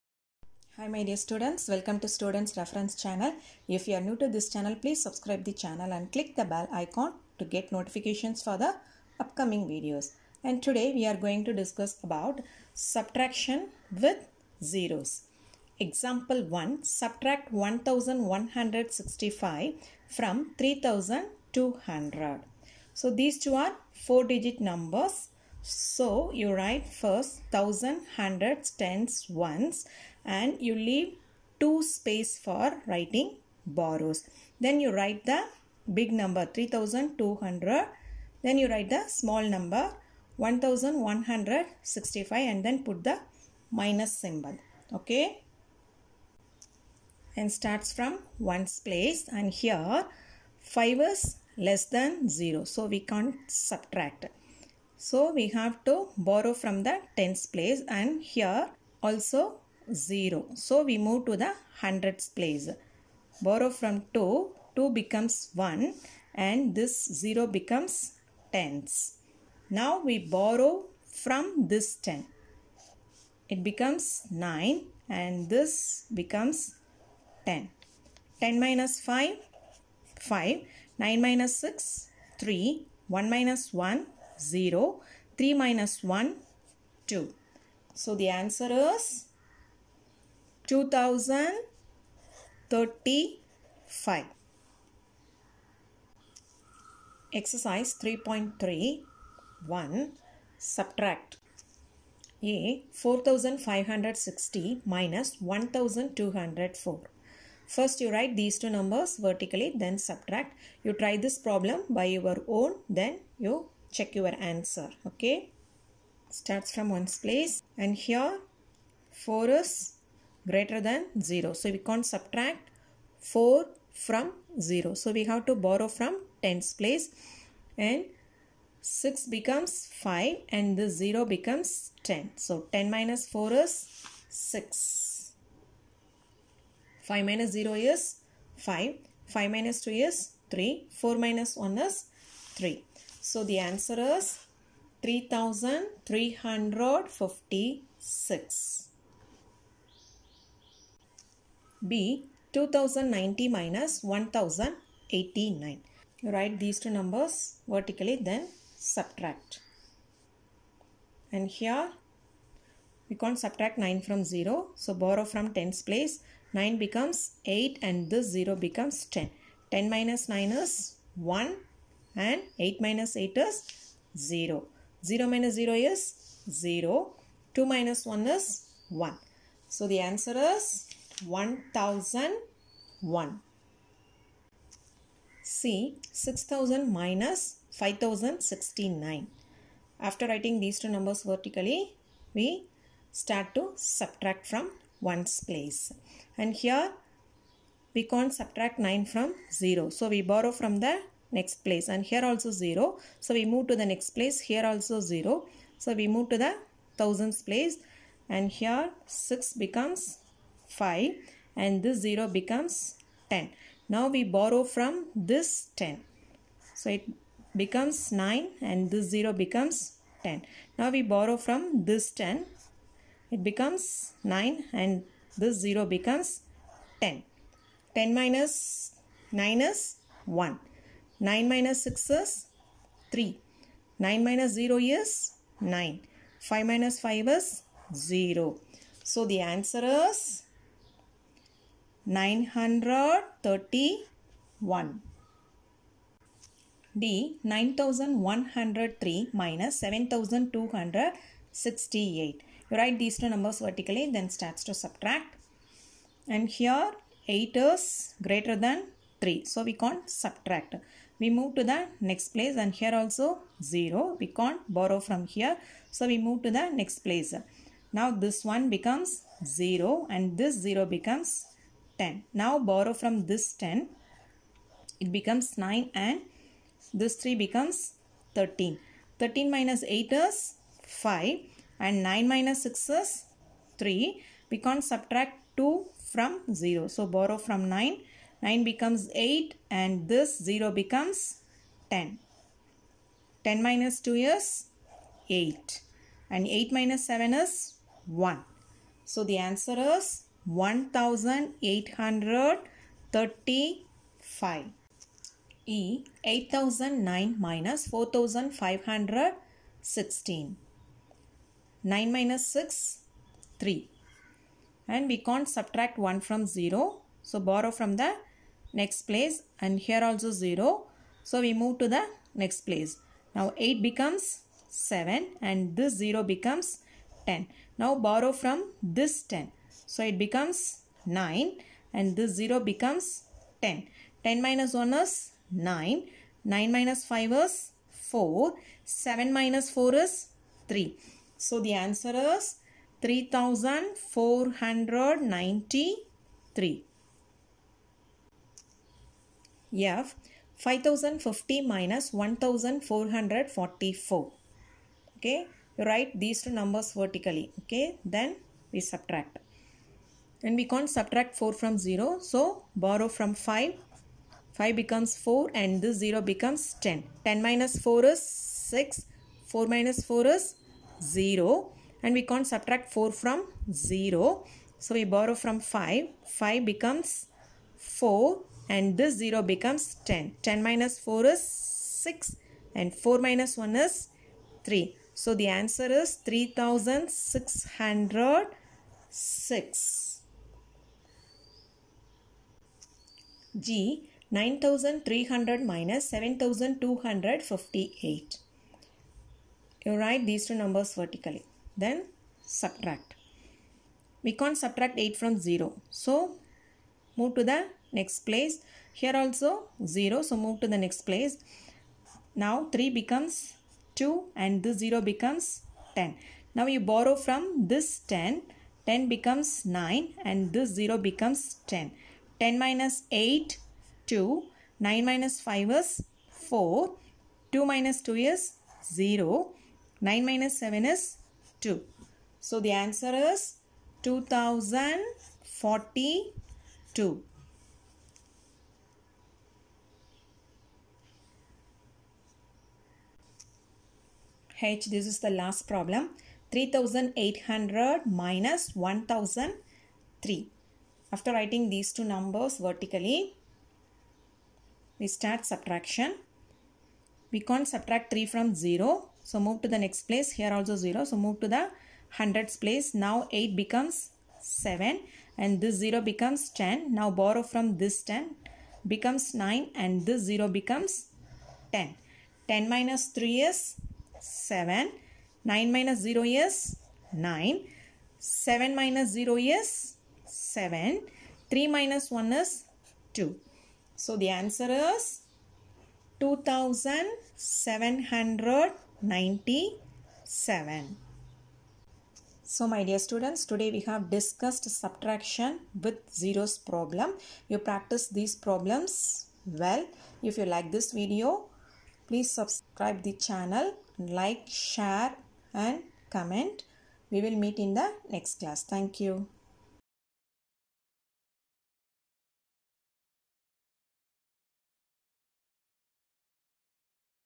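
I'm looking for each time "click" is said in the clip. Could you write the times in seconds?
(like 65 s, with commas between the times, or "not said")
6 s.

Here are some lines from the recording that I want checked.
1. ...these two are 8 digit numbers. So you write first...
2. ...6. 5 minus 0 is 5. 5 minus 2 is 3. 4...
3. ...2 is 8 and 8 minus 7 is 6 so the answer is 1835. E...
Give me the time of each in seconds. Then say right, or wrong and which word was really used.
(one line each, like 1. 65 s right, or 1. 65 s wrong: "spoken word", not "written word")
1. 23 s wrong: "4", not "8"
2. 134 s right
3. 294 s wrong: "1", not "6".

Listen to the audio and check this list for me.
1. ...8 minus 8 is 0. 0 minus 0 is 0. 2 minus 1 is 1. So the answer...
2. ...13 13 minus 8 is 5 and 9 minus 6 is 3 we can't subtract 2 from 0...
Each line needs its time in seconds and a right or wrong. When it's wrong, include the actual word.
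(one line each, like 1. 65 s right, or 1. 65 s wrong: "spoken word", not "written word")
1. 172 s right
2. 278 s right.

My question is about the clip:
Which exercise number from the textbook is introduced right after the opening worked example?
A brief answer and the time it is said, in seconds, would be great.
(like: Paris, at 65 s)
Exercise 3.3, at 97 s.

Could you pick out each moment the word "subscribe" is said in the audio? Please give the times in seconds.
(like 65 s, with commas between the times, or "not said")
5 s, 502 s.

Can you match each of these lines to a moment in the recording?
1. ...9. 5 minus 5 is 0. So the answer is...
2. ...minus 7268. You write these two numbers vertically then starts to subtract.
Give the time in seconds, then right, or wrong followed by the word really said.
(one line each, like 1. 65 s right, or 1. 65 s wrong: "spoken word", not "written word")
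1. 235 s right
2. 249 s right.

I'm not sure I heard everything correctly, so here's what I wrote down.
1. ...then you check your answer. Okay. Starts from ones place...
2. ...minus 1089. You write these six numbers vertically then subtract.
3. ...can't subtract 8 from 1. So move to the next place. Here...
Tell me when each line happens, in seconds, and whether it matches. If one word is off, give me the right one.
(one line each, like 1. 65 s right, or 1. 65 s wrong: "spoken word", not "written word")
1. 112 s right
2. 153 s wrong: "two", not "six"
3. 404 s wrong: "0", not "1".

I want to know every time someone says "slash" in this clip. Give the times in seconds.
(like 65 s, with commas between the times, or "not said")
not said.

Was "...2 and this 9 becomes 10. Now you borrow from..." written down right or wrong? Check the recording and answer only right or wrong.
wrong.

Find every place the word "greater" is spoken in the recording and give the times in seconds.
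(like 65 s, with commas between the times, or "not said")
120 s, 258 s.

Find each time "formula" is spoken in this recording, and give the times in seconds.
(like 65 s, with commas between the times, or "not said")
not said.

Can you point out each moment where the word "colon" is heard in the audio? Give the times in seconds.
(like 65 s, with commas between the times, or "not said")
not said.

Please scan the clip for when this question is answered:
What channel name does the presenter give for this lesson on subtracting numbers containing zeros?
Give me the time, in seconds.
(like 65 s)
2 s.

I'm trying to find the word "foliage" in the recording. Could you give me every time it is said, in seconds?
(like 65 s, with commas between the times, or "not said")
not said.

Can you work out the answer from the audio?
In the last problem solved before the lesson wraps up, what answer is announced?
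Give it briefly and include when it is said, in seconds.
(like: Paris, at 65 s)
2797, at 486 s.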